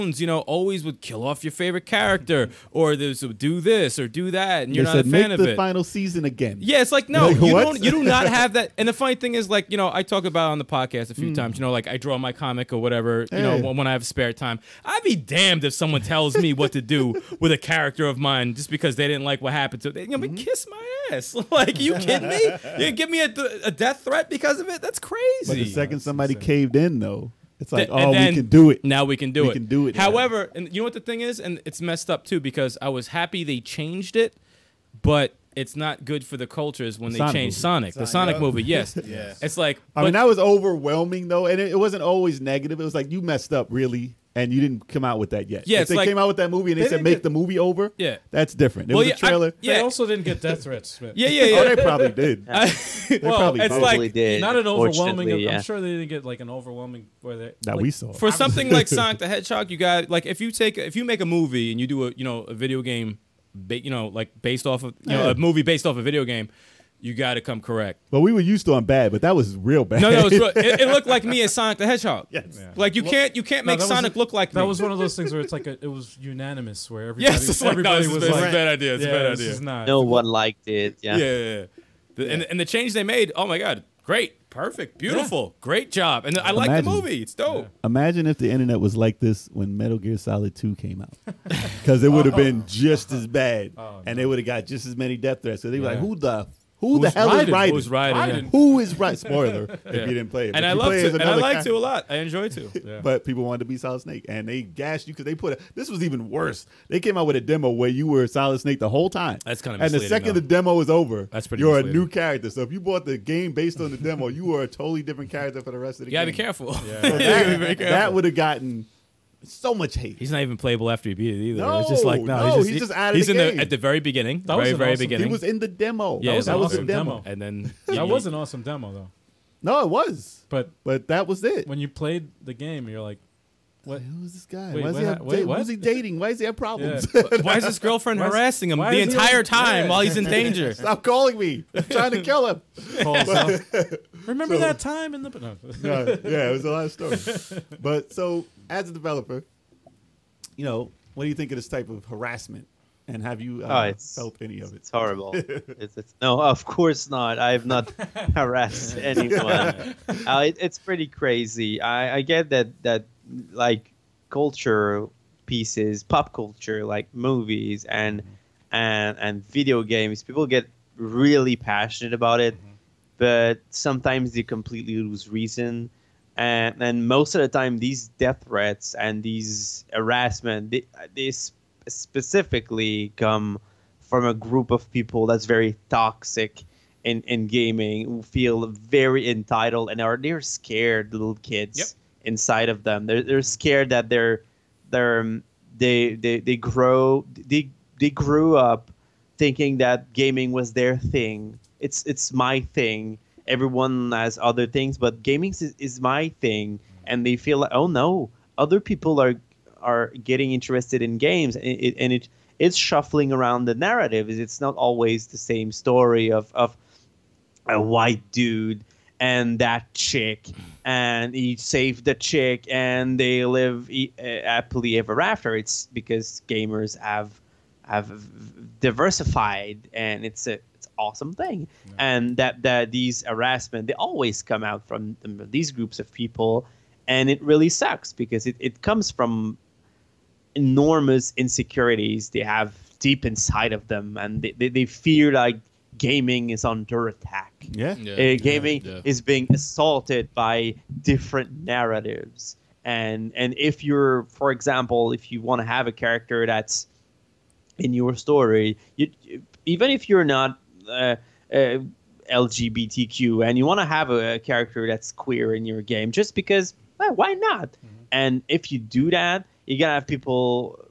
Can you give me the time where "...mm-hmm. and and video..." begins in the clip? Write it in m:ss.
2:48.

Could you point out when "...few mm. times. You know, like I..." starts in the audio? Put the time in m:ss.
0:11.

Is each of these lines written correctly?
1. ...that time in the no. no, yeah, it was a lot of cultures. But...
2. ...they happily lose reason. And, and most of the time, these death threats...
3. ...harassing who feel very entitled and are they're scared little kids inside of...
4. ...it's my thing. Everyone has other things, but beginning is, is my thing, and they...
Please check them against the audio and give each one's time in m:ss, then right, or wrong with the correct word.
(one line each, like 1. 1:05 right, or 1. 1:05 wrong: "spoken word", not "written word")
1. 2:24 wrong: "stories", not "cultures"
2. 2:54 wrong: "completely", not "happily"
3. 3:07 wrong: "gaming", not "harassing"
4. 3:22 wrong: "gaming", not "beginning".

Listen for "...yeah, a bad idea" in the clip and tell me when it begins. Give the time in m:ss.
1:19.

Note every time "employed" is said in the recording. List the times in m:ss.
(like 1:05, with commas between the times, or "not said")
not said.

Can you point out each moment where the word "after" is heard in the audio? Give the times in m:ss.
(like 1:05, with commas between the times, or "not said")
2:00, 3:45.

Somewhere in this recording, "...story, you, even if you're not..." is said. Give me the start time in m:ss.
4:18.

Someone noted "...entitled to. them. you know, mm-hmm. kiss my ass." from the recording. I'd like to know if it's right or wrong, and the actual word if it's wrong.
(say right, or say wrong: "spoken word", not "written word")
wrong: "happened", not "entitled".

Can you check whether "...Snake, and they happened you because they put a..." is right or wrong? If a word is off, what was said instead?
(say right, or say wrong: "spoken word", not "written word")
wrong: "gashed", not "happened".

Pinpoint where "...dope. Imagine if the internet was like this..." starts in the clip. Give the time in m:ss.
1:27.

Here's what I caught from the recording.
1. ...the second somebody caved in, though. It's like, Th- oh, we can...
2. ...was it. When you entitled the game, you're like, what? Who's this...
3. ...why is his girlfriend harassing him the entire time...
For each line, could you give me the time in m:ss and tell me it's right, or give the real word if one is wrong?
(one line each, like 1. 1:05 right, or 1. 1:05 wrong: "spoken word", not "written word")
1. 0:25 right
2. 2:11 wrong: "played", not "entitled"
3. 2:17 right.